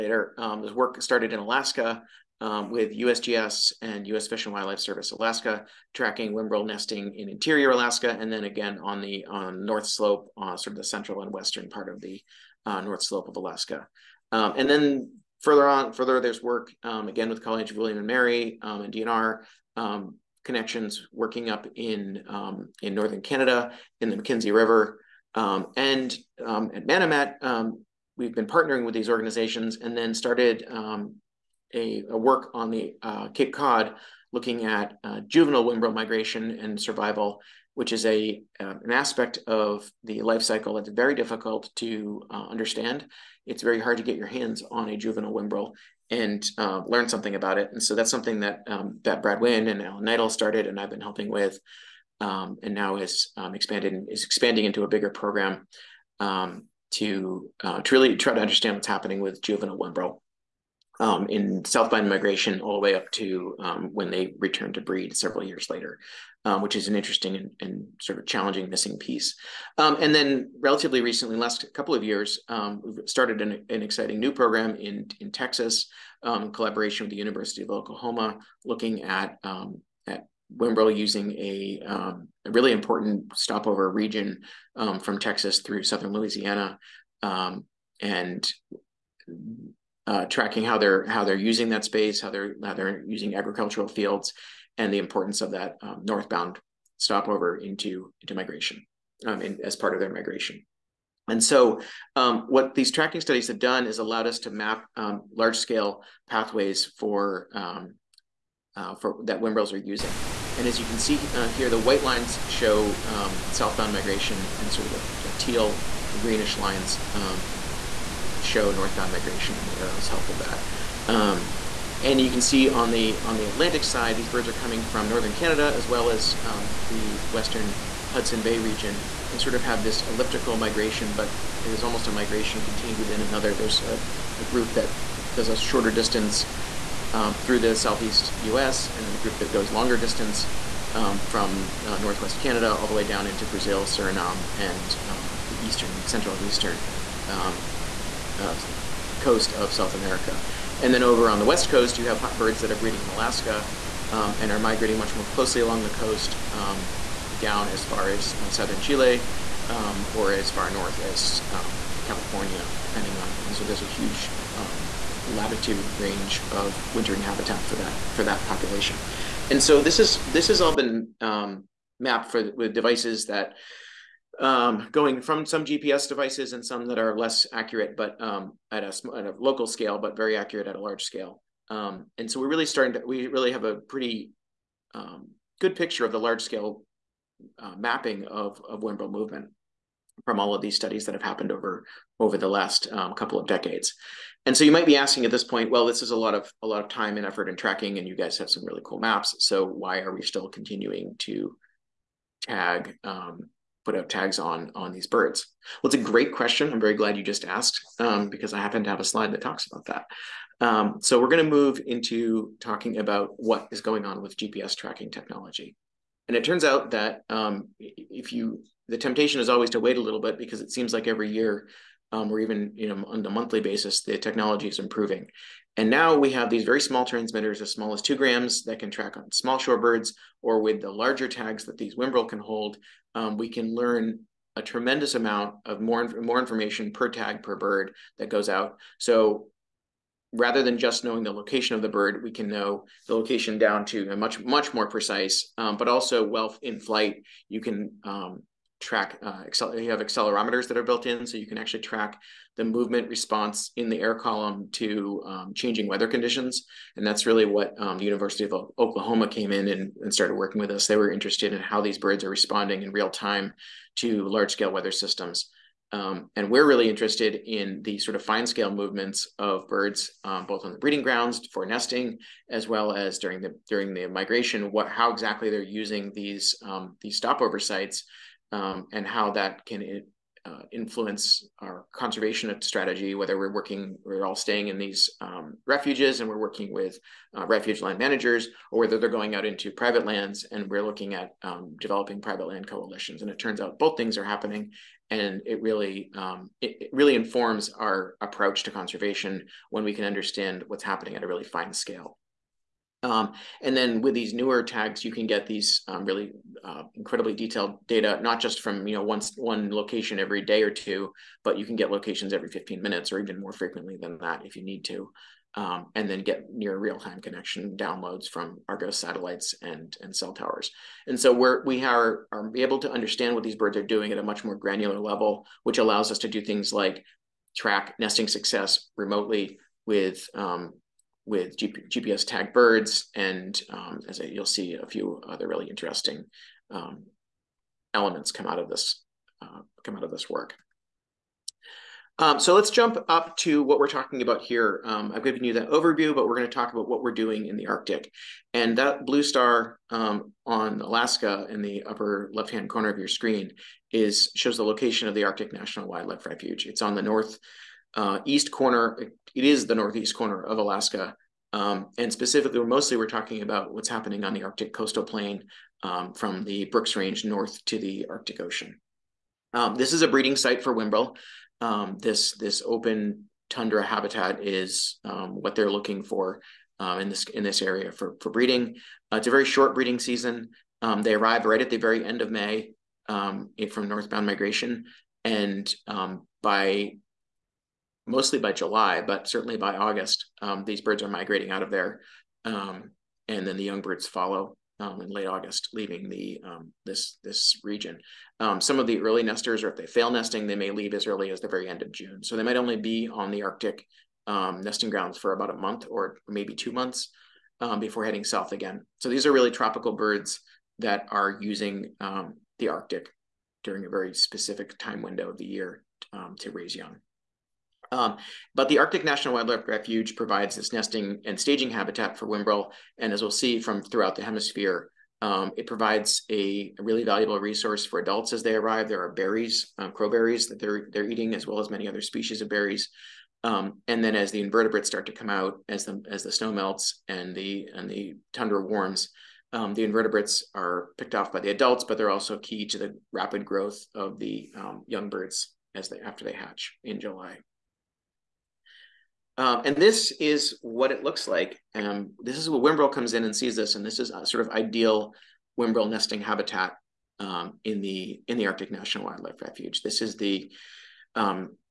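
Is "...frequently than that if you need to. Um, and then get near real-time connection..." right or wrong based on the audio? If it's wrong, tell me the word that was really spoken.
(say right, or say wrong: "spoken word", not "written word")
right.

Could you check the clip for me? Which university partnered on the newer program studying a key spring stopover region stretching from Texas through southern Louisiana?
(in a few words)
University of Oklahoma.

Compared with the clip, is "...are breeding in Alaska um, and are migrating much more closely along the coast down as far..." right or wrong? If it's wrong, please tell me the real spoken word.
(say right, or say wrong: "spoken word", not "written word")
right.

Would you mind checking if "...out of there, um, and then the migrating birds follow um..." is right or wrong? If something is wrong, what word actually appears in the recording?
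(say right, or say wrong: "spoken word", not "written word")
wrong: "young", not "migrating".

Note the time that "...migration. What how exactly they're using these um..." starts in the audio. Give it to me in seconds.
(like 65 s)
274 s.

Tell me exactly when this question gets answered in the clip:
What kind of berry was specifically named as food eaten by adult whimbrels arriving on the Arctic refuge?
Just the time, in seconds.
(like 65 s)
429 s.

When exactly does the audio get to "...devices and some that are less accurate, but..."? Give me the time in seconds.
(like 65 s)
176 s.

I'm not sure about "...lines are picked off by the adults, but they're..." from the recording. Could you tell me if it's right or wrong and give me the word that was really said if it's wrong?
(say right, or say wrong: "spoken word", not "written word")
wrong: "invertebrates", not "lines".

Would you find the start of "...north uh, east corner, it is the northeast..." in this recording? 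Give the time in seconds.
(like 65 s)
357 s.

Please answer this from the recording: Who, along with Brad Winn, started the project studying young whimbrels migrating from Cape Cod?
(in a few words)
Alan Kneidel.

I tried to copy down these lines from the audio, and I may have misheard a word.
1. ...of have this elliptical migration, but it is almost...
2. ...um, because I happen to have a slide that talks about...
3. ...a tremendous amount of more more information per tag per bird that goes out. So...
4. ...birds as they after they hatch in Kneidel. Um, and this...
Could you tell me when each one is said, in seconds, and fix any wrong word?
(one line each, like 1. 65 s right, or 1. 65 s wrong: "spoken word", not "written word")
1. 129 s right
2. 207 s right
3. 234 s right
4. 445 s wrong: "July", not "Kneidel".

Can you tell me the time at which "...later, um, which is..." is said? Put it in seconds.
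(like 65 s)
65 s.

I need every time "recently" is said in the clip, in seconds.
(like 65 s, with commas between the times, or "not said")
71 s.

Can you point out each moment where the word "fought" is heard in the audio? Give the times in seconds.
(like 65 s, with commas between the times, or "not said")
not said.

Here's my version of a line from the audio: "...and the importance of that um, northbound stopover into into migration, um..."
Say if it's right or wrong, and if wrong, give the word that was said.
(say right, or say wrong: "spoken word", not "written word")
right.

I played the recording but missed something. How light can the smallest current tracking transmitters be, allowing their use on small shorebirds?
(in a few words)
2 grams.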